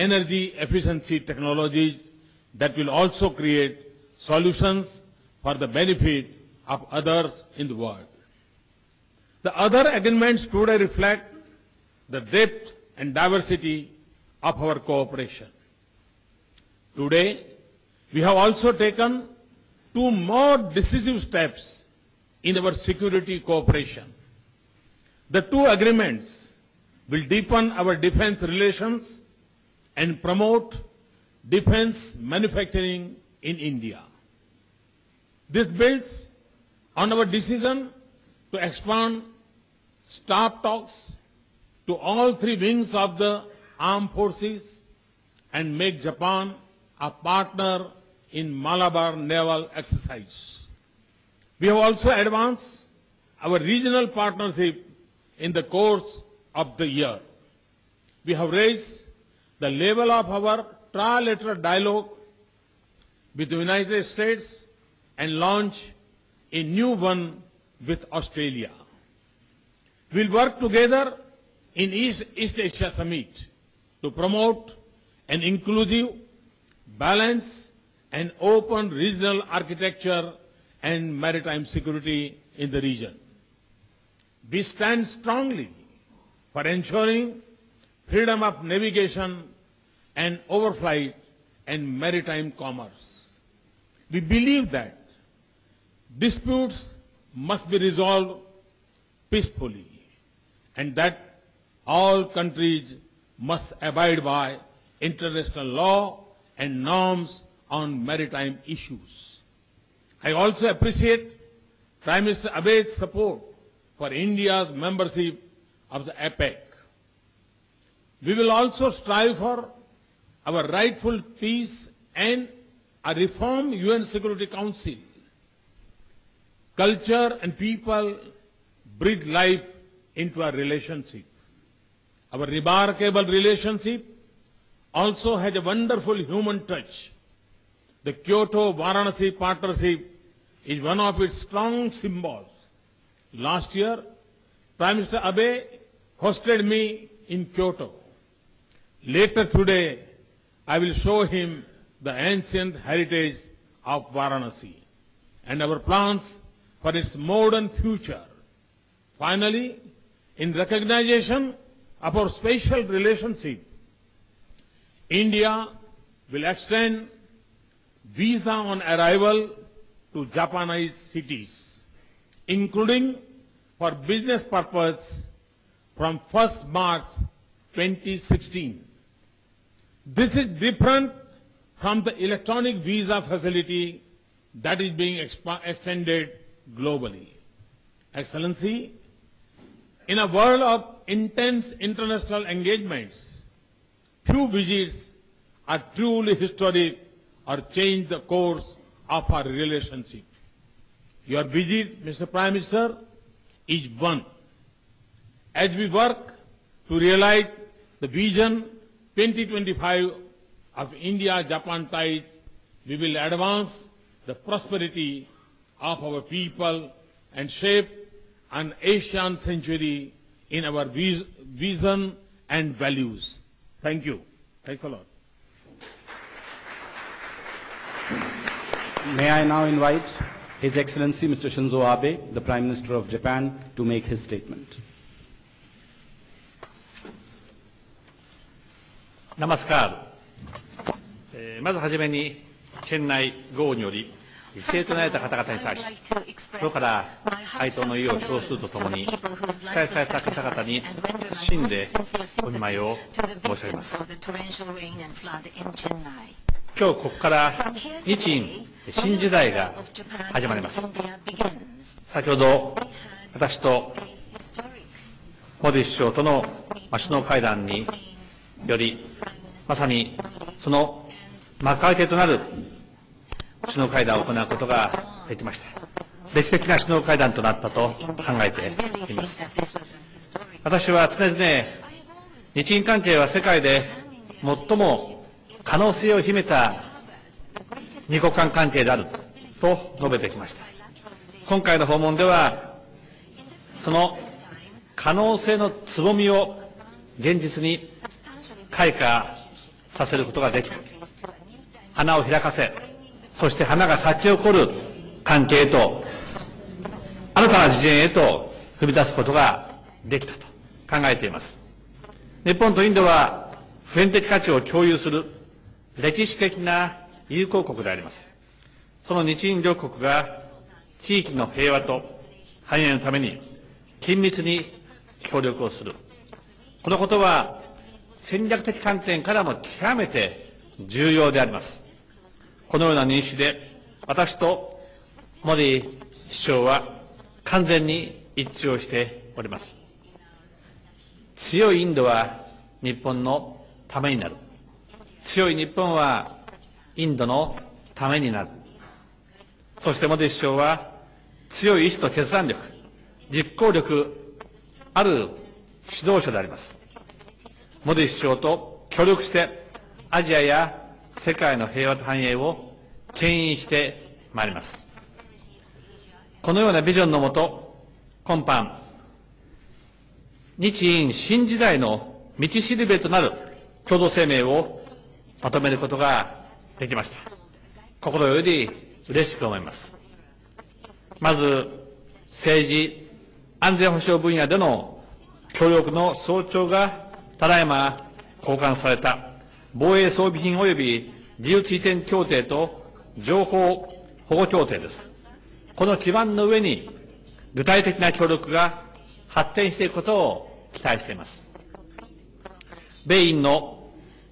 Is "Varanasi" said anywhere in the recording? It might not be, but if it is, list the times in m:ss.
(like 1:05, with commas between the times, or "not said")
2:18, 2:34.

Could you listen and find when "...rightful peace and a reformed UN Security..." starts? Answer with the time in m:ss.
2:00.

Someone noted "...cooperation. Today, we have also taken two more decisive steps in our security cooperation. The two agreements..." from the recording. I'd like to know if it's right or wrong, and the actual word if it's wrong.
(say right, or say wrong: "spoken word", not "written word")
right.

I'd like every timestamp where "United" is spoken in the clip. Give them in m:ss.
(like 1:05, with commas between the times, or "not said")
1:03.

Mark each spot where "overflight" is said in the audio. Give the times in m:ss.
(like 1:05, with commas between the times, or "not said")
1:30.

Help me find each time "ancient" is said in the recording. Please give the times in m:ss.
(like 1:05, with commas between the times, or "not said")
2:32.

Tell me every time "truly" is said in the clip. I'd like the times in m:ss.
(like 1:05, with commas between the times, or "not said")
3:15.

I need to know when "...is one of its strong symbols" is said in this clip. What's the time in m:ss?
2:20.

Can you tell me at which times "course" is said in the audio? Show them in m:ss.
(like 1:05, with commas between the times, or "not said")
0:55, 3:18.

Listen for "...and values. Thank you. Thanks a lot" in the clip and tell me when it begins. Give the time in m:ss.
3:42.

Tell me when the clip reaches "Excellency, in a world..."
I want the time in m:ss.
3:08.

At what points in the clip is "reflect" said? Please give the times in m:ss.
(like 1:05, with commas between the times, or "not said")
0:10.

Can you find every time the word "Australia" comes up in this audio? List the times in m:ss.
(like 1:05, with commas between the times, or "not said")
1:08.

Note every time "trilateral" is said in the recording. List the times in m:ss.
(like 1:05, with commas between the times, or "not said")
1:00.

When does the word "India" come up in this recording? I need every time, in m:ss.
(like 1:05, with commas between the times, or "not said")
0:33, 1:54, 2:45, 3:30.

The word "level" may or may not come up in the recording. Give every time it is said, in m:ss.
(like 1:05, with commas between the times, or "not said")
0:59.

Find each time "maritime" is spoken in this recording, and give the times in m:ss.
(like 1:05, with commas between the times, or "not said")
1:21, 1:31, 1:48.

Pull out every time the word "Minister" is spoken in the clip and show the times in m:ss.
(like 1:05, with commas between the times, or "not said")
1:52, 2:24, 3:22, 3:52.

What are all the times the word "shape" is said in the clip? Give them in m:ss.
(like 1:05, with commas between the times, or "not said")
3:37.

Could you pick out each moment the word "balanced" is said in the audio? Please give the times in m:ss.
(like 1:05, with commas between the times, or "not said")
1:16.